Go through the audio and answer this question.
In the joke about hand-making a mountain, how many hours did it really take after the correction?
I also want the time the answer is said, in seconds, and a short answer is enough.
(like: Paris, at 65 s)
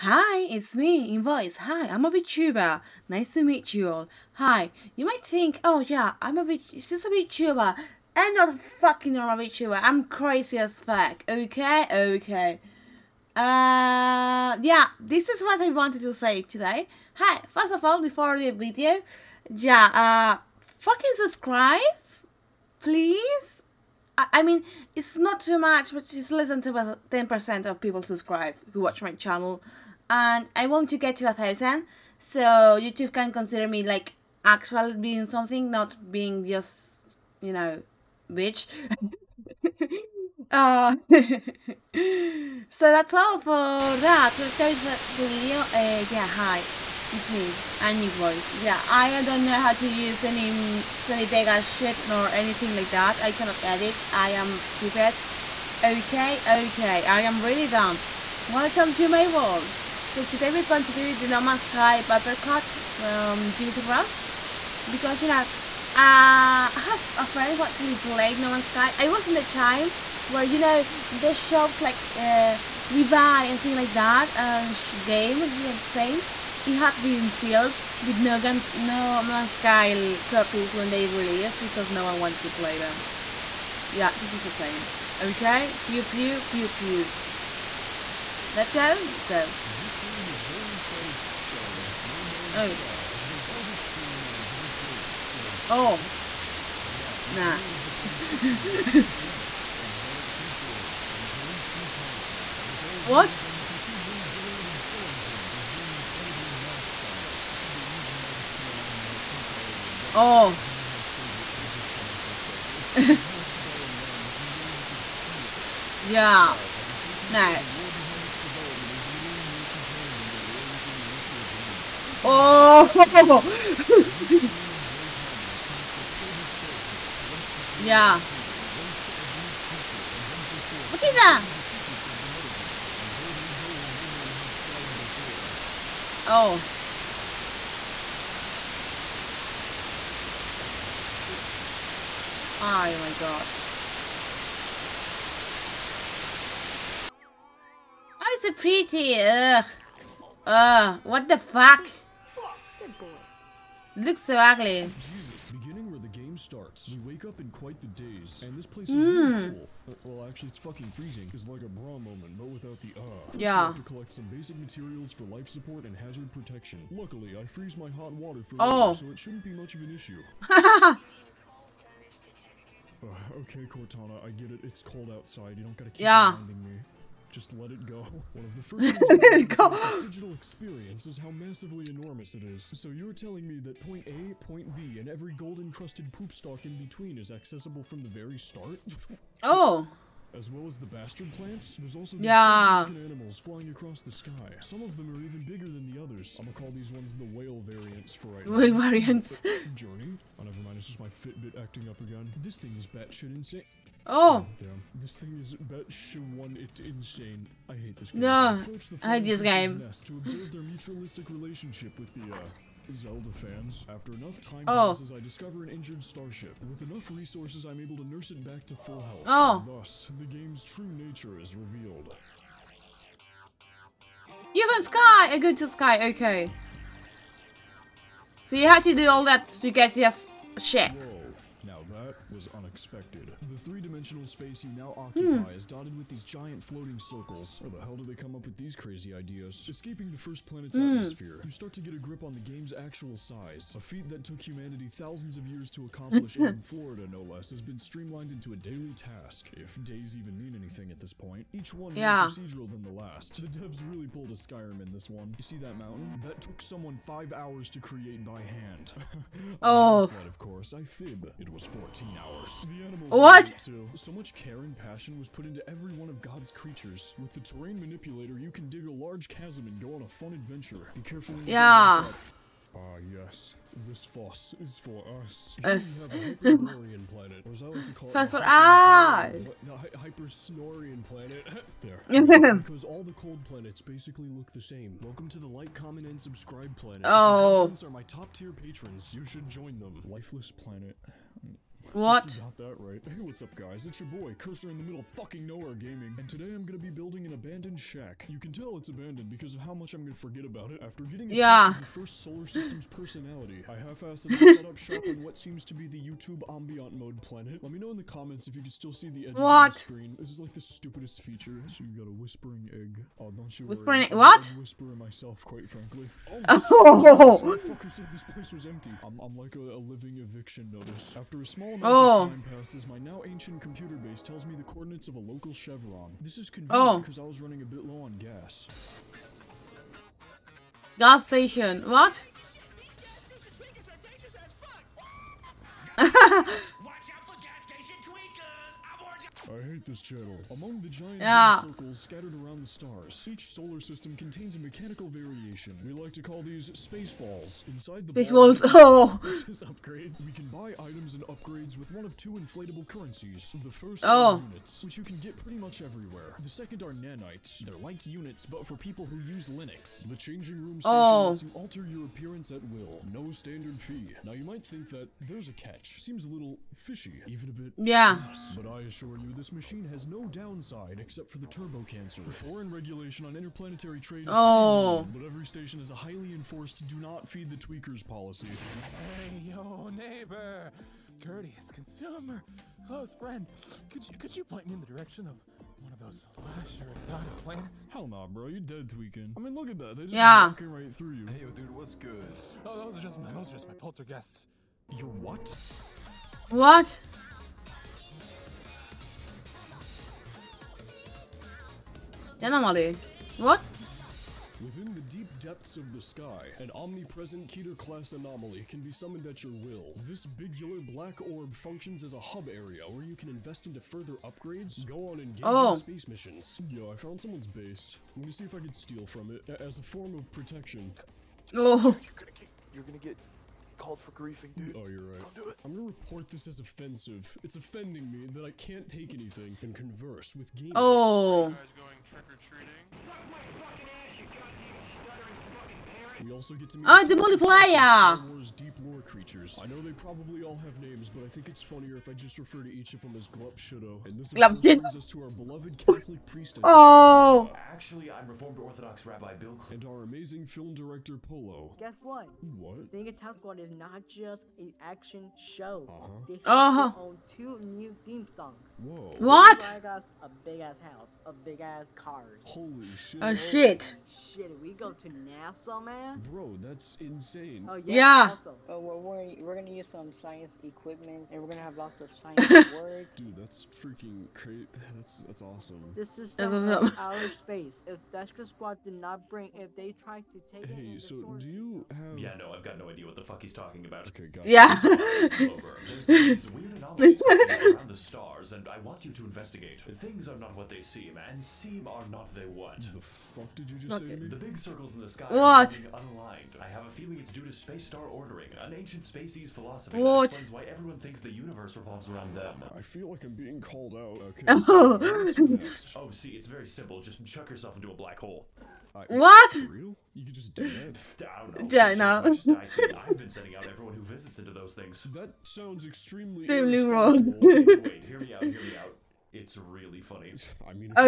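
14, at 261 s.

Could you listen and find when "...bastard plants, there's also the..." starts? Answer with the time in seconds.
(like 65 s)
190 s.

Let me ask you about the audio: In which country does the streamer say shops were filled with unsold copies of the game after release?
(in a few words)
Spain.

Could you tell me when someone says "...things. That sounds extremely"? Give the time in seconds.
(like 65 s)
514 s.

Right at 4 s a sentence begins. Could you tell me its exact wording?
Hi, you might think, oh yeah, I'm a v- is a VTuber?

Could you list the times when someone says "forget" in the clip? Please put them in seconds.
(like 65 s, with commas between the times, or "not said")
300 s.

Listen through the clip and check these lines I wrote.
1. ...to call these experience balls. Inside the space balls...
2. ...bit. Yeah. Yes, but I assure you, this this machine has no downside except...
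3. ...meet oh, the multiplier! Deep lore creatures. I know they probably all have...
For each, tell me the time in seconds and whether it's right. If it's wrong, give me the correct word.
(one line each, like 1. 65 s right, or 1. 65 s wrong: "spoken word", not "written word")
1. 346 s wrong: "space", not "experience"
2. 367 s right
3. 436 s right.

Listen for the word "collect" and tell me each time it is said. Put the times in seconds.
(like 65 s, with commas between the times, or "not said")
127 s, 163 s.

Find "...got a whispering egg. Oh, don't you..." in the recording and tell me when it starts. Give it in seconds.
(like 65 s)
311 s.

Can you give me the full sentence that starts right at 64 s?
Because, you know, uh, I have a friend who actually played No Man's Sky.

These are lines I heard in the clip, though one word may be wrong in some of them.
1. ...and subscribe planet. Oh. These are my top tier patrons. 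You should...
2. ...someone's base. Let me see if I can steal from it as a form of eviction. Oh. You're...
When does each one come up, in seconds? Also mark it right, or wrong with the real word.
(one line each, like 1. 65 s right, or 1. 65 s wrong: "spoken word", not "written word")
1. 286 s right
2. 417 s wrong: "protection", not "eviction".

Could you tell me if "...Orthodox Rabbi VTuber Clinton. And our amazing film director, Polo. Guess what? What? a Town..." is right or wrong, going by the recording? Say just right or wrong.
wrong.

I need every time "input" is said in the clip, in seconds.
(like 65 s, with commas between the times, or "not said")
not said.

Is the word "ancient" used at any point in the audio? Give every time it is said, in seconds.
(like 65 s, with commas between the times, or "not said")
323 s, 498 s.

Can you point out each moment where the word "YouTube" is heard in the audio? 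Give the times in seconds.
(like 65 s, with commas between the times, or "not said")
32 s, 305 s.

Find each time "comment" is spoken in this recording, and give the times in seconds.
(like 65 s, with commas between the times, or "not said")
285 s, 308 s.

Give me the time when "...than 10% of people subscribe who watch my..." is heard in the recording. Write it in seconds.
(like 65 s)
26 s.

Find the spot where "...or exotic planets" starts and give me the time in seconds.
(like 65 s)
386 s.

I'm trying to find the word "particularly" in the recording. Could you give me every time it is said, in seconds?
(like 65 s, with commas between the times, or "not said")
not said.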